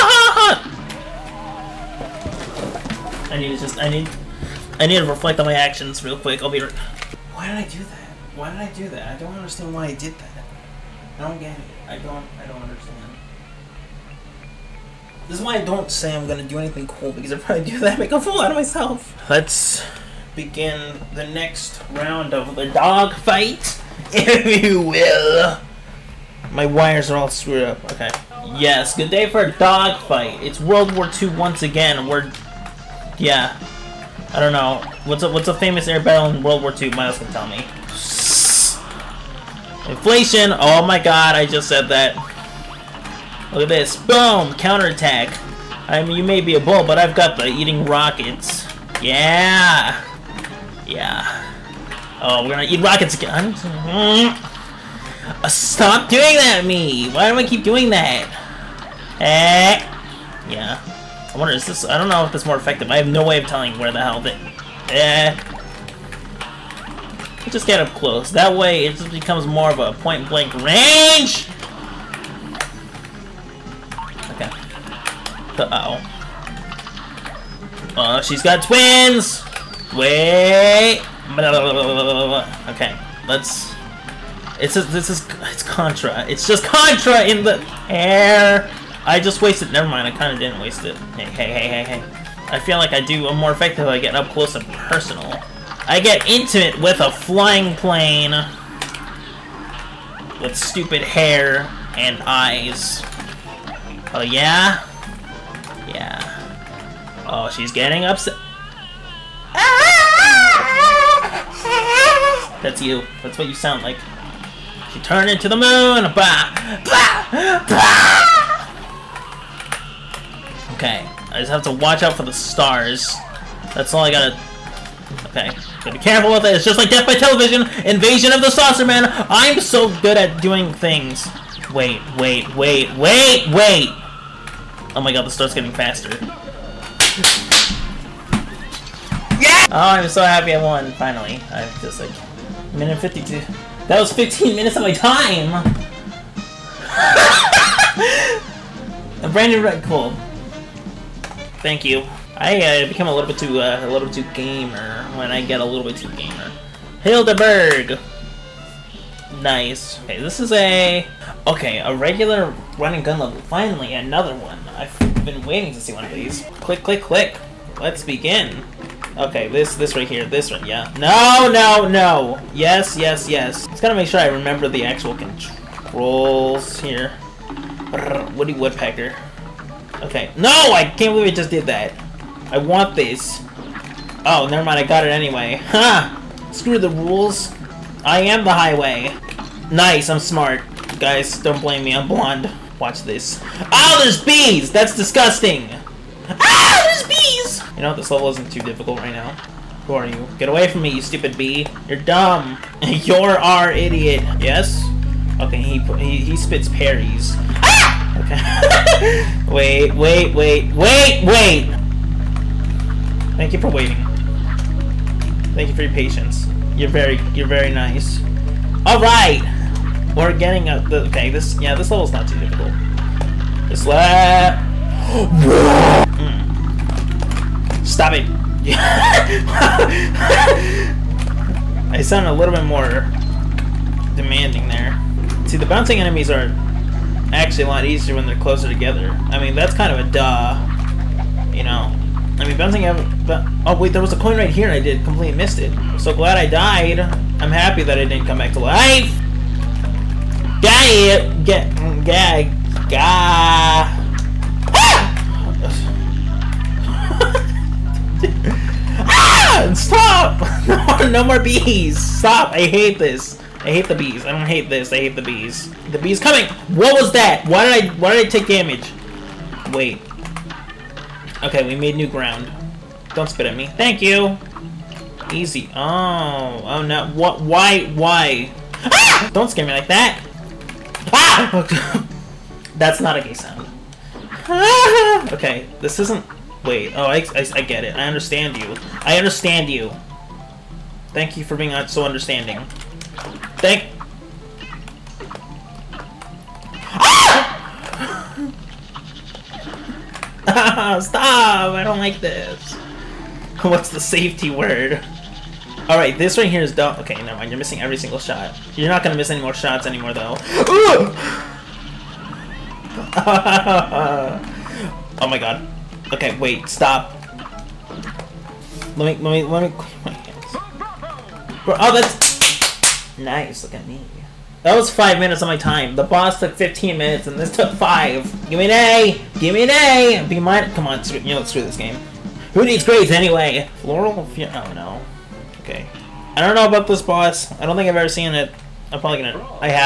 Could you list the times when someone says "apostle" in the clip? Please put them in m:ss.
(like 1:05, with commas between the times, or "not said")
not said.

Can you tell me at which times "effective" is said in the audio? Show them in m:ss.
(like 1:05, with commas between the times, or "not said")
1:02, 1:33.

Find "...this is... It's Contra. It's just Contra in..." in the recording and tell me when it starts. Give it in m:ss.
1:24.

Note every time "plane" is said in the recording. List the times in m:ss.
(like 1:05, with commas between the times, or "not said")
1:37.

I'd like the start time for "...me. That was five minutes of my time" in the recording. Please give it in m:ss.
5:23.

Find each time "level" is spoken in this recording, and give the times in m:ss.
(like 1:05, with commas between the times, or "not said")
2:43, 3:18, 3:41.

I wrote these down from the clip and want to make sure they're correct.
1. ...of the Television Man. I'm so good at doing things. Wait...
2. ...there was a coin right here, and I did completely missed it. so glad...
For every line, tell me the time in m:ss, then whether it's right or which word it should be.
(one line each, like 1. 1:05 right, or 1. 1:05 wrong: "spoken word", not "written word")
1. 2:08 wrong: "Saucer", not "Television"
2. 4:03 right.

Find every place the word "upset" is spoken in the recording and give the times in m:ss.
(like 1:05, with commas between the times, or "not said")
1:48.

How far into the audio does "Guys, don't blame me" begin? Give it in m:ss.
3:10.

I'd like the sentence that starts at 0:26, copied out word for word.
My wires are all screwed up.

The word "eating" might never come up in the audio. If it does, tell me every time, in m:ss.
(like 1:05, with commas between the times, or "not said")
0:47.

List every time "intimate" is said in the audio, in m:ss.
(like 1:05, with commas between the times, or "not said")
1:36.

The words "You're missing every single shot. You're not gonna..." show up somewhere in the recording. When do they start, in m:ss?
5:07.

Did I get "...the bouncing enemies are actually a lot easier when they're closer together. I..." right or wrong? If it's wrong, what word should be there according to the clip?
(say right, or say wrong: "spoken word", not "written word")
right.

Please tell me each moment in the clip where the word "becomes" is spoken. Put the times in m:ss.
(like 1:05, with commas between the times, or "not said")
1:09, 2:32.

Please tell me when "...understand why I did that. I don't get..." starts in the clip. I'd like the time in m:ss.
0:09.